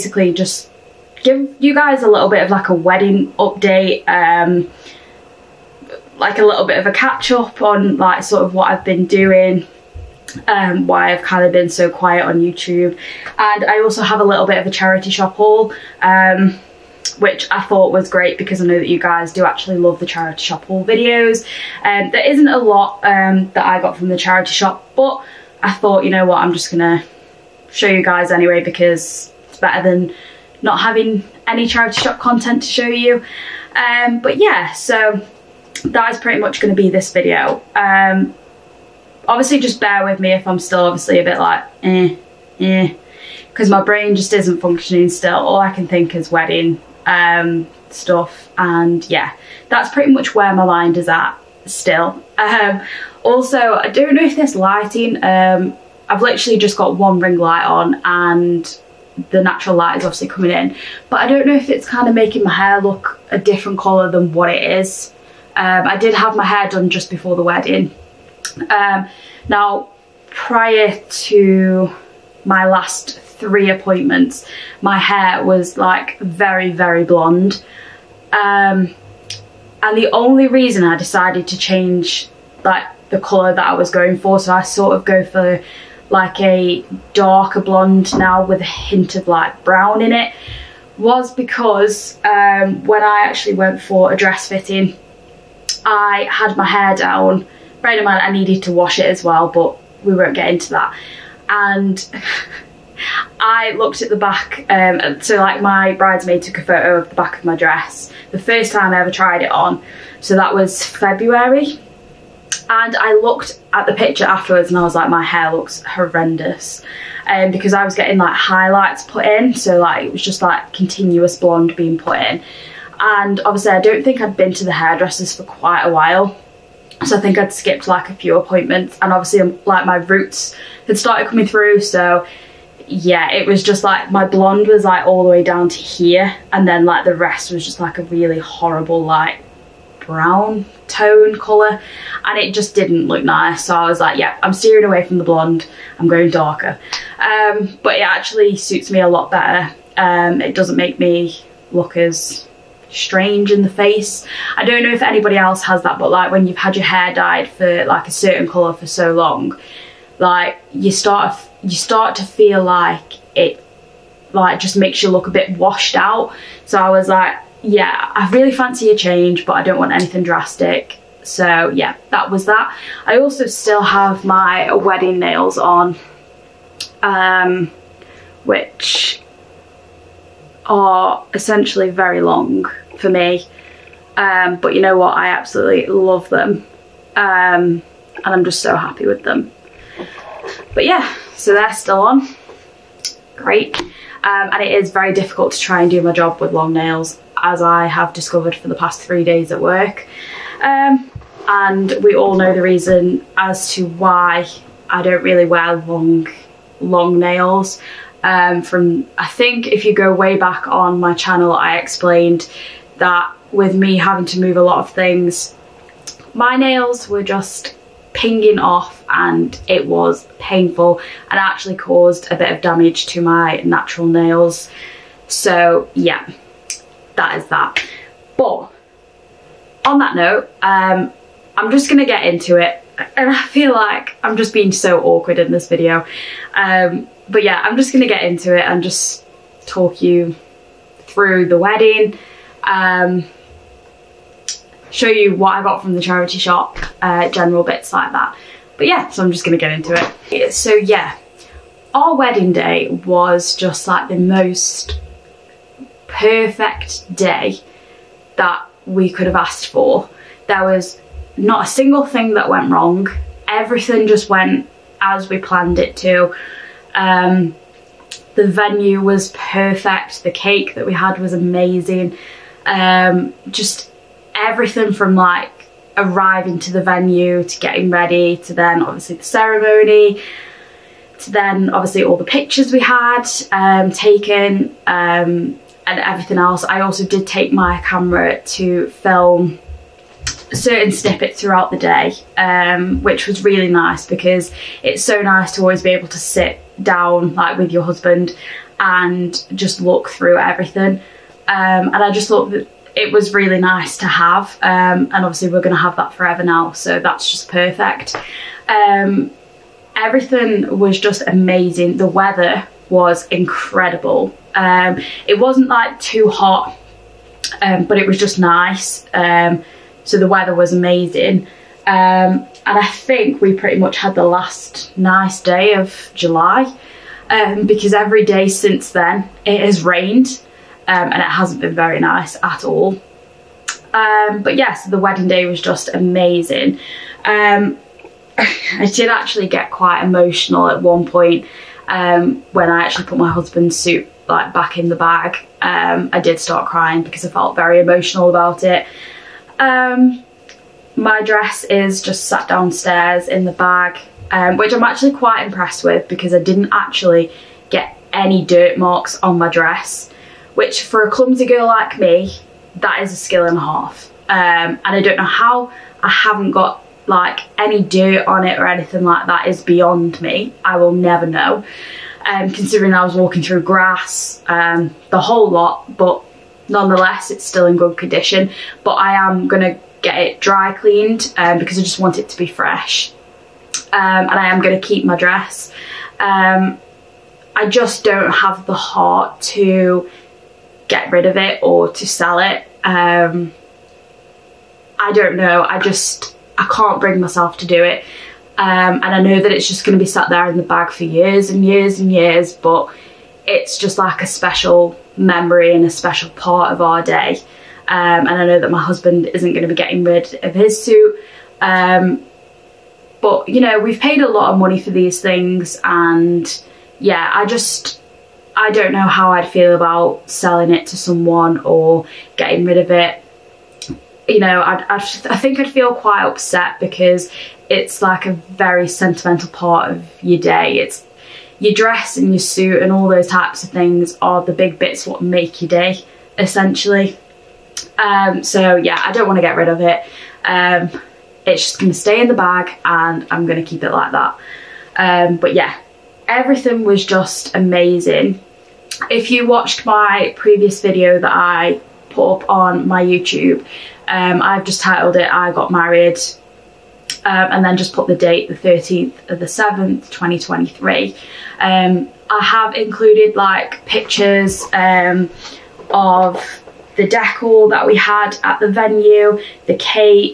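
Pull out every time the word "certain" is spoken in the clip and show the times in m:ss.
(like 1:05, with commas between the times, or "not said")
2:38, 4:50.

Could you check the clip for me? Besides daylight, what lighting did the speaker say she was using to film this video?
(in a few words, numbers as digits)
1 ring light.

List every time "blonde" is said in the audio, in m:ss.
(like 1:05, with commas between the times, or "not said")
1:17, 1:27, 2:01, 2:14, 2:25.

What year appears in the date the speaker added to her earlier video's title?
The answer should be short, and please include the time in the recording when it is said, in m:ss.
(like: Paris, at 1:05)
2023, at 7:40.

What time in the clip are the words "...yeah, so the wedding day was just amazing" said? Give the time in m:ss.
5:34.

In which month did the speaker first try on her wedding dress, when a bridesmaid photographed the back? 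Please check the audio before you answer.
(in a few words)
February.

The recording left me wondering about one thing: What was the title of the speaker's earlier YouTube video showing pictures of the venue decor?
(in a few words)
I Got Married.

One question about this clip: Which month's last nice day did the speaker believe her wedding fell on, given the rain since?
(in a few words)
July.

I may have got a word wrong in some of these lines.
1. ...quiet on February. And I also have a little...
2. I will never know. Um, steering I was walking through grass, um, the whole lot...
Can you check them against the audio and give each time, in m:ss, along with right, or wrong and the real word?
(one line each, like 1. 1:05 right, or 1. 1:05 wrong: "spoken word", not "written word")
1. 0:11 wrong: "YouTube", not "February"
2. 6:10 wrong: "considering", not "steering".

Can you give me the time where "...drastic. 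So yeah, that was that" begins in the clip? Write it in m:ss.
2:50.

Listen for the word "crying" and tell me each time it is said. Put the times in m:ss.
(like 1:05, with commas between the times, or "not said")
5:46.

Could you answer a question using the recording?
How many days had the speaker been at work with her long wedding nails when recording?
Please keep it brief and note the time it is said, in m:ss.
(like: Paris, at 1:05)
3, at 3:19.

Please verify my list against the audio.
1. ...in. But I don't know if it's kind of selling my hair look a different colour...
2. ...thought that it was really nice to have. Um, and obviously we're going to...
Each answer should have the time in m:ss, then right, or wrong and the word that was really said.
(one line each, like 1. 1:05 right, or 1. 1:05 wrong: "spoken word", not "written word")
1. 1:00 wrong: "making", not "selling"
2. 5:02 right.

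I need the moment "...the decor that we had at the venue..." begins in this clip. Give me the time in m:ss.
7:46.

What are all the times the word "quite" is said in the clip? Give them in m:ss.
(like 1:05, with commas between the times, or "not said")
2:05, 5:39, 5:55, 7:05.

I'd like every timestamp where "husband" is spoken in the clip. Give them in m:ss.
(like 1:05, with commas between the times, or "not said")
4:57, 5:43, 6:48.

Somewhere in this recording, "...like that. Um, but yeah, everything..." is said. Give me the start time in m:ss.
7:23.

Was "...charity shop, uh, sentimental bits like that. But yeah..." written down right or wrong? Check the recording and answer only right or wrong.
wrong.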